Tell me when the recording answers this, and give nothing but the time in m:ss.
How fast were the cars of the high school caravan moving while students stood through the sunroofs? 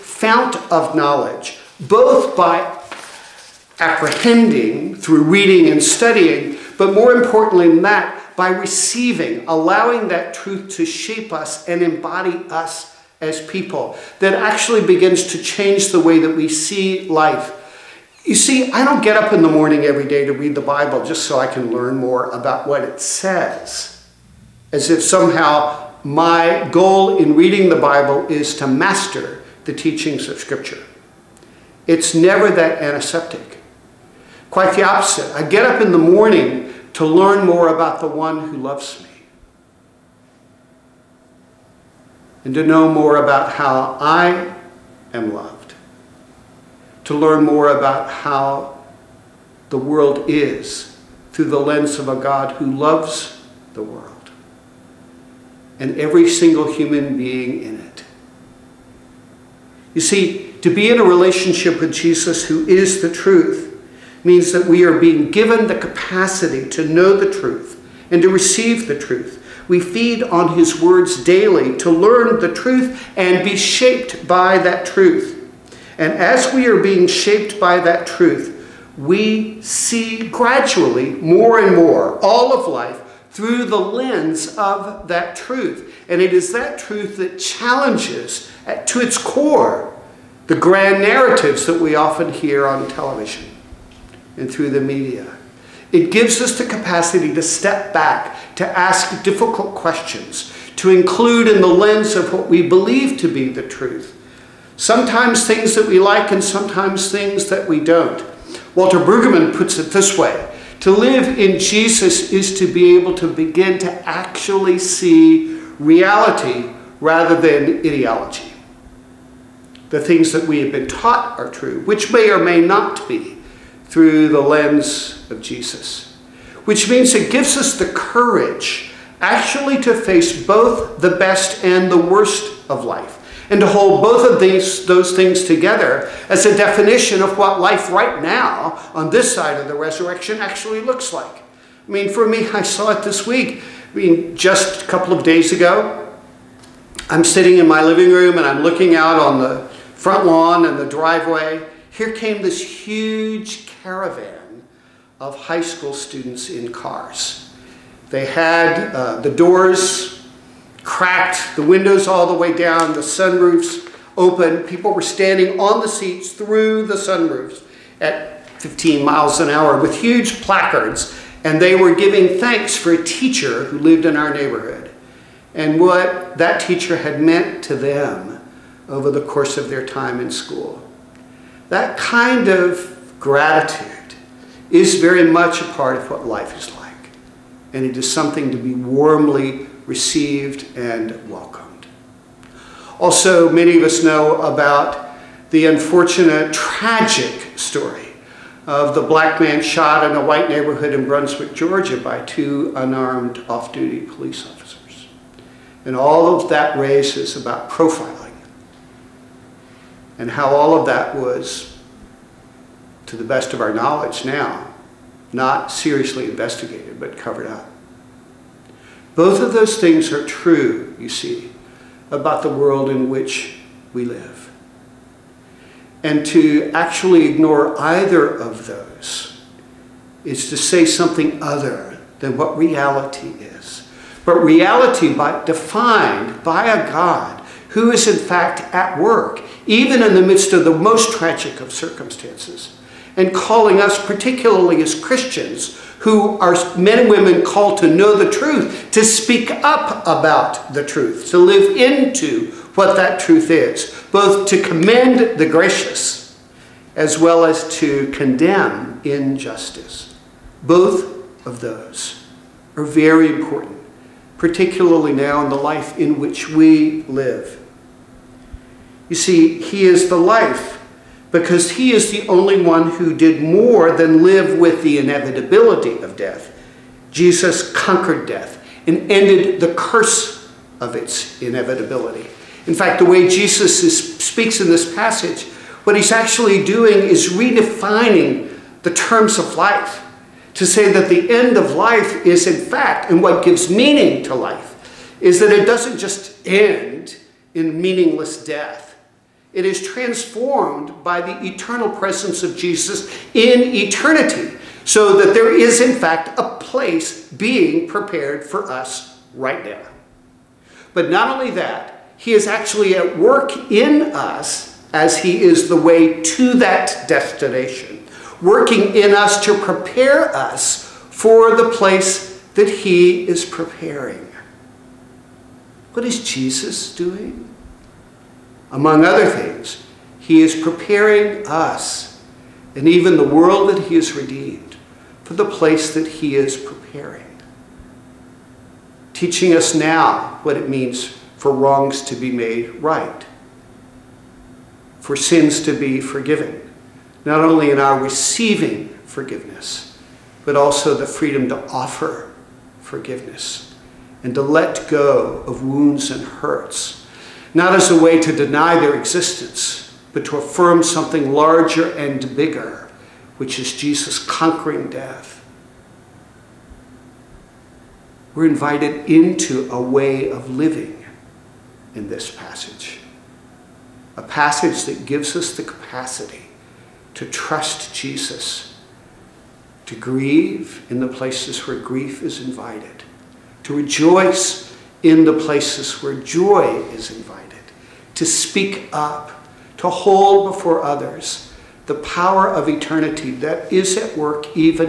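2:48.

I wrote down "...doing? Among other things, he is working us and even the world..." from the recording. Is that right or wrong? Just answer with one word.
wrong.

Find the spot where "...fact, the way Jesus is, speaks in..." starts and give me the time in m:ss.
4:42.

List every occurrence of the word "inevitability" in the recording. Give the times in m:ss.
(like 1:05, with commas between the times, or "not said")
4:34, 4:41.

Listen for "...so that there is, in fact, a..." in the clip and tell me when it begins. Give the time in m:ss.
5:04.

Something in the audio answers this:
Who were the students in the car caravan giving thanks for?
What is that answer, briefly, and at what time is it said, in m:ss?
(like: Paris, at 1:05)
A teacher, at 2:52.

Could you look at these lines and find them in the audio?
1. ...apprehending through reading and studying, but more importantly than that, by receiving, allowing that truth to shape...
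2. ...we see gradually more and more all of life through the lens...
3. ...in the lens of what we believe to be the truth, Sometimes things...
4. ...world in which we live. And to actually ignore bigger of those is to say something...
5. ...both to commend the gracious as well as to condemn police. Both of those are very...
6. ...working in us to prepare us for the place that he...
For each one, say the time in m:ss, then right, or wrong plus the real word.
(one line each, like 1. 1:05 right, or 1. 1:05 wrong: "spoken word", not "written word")
1. 0:03 right
2. 1:18 right
3. 1:41 right
4. 3:42 wrong: "either", not "bigger"
5. 4:14 wrong: "injustice", not "police"
6. 5:18 right.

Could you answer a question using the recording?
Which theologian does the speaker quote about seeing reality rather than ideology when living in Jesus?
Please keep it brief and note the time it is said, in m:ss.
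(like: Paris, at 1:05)
Walter Brueggemann, at 1:48.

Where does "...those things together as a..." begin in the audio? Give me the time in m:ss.
2:14.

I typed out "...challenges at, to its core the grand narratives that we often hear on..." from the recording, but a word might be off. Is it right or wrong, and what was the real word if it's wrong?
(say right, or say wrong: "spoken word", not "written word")
right.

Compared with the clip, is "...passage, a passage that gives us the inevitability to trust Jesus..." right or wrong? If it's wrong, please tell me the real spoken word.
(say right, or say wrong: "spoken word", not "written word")
wrong: "capacity", not "inevitability".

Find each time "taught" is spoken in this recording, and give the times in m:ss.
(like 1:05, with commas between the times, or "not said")
2:00.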